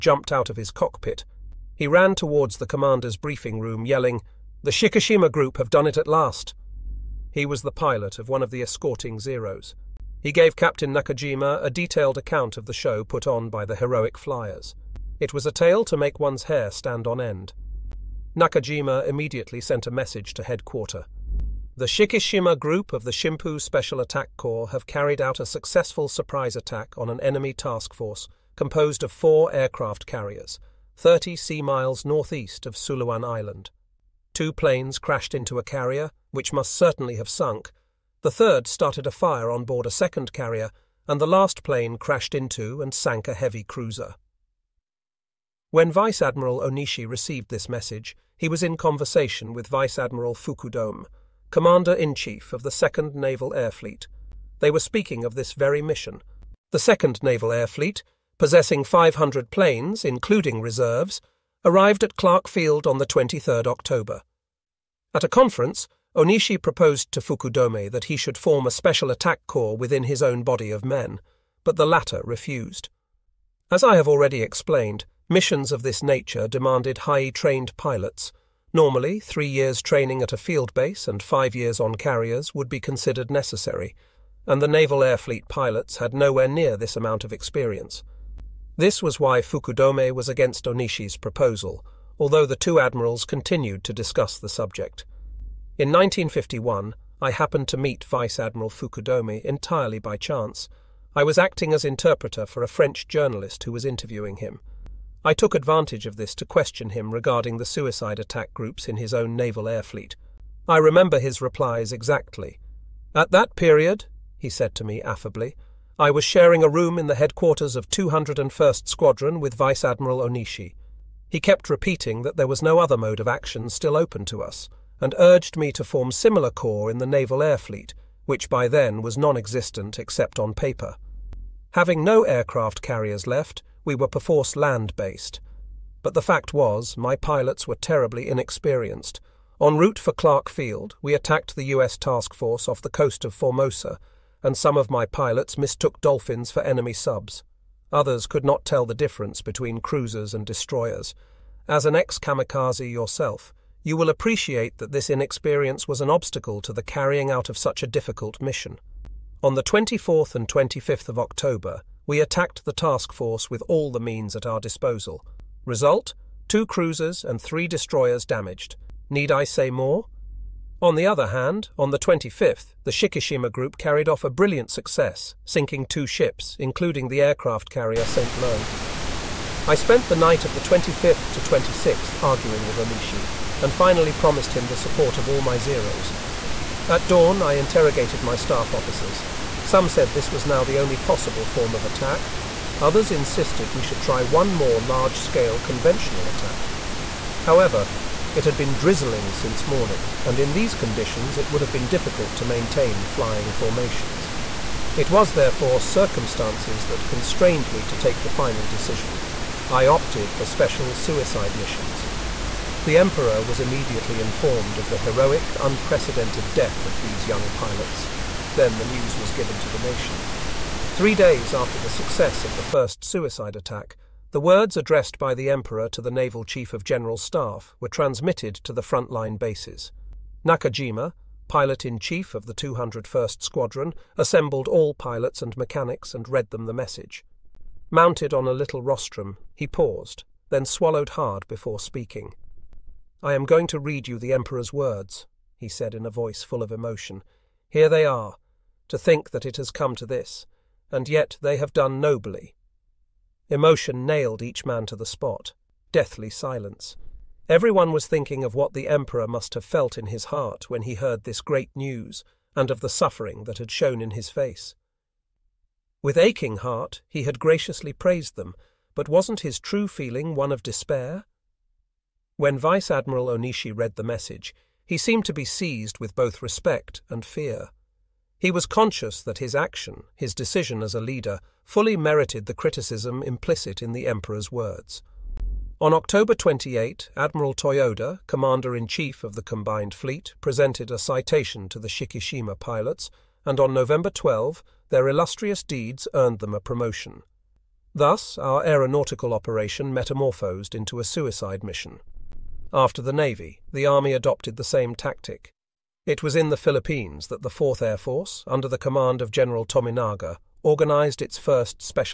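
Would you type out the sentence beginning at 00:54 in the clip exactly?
They were speaking of this very mission.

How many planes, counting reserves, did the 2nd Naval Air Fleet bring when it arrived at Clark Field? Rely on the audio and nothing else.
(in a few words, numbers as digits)
500.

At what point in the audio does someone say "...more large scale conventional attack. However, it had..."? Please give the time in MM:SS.
03:14.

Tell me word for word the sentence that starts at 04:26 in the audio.
With aching heart, he had graciously praised them, but wasn't his true feeling one of despair?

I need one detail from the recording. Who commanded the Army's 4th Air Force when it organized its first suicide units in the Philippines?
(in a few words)
General Tominaga.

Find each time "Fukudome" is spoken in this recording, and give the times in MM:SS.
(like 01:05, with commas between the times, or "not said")
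00:50, 01:07, 01:29, 01:38.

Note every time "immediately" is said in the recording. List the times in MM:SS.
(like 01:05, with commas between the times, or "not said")
00:19, 03:33.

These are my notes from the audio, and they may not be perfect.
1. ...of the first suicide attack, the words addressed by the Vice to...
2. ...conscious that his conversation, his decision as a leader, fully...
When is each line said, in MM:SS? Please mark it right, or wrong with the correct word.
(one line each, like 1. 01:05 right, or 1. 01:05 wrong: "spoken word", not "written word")
1. 03:42 wrong: "Emperor", not "Vice"
2. 04:38 wrong: "action", not "conversation".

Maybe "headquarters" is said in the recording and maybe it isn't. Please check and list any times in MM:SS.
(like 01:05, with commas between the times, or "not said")
00:20, 01:57.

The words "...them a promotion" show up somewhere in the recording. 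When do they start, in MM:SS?
04:56.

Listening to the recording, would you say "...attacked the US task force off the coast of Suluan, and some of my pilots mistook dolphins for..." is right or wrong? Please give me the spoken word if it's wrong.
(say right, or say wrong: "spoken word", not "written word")
wrong: "Formosa", not "Suluan".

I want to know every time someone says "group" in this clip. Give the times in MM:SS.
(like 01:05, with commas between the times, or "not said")
00:05, 00:22, 01:48, 02:53.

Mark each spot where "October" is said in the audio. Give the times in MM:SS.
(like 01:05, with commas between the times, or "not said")
01:03, 02:41, 04:45.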